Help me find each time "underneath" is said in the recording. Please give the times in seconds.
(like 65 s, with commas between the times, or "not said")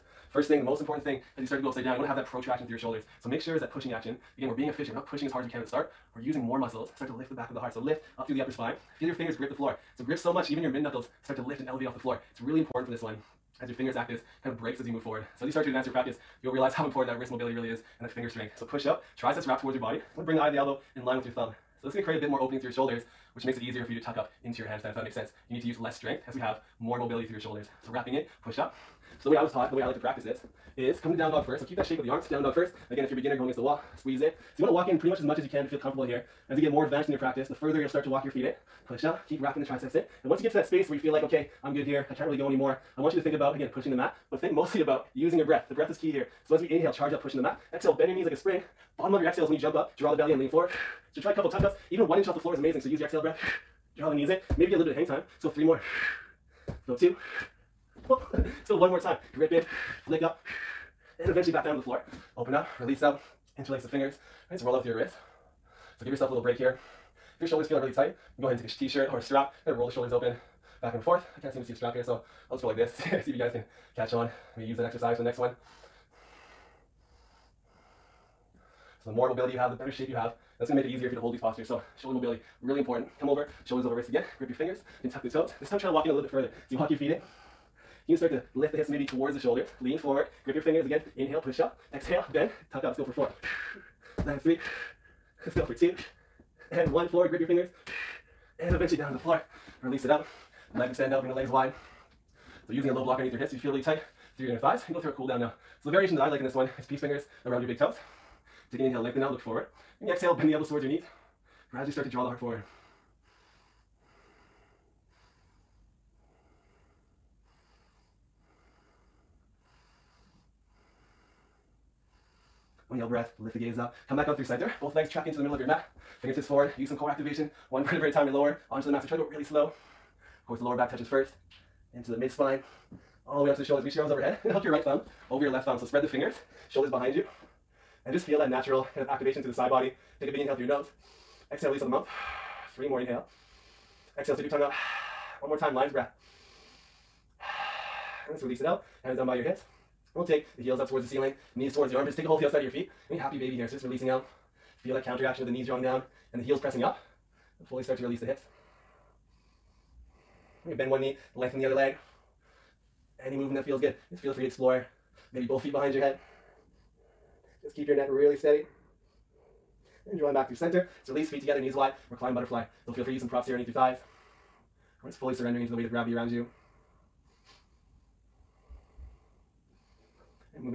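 103 s, 173 s.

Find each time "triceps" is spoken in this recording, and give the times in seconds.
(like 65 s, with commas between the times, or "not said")
19 s, 39 s.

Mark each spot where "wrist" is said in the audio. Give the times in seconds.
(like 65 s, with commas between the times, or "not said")
17 s, 64 s, 83 s.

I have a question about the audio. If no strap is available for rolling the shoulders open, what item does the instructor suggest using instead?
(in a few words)
t-shirt.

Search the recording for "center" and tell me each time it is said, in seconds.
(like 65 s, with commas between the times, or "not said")
124 s, 170 s.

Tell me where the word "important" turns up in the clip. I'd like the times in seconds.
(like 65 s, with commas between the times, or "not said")
0 s, 12 s, 16 s, 82 s.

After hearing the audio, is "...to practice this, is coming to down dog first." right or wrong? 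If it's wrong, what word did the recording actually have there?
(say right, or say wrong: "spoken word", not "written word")
right.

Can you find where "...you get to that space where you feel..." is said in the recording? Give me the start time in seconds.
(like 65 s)
40 s.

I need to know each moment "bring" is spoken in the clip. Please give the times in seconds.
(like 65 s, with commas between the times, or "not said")
20 s, 101 s.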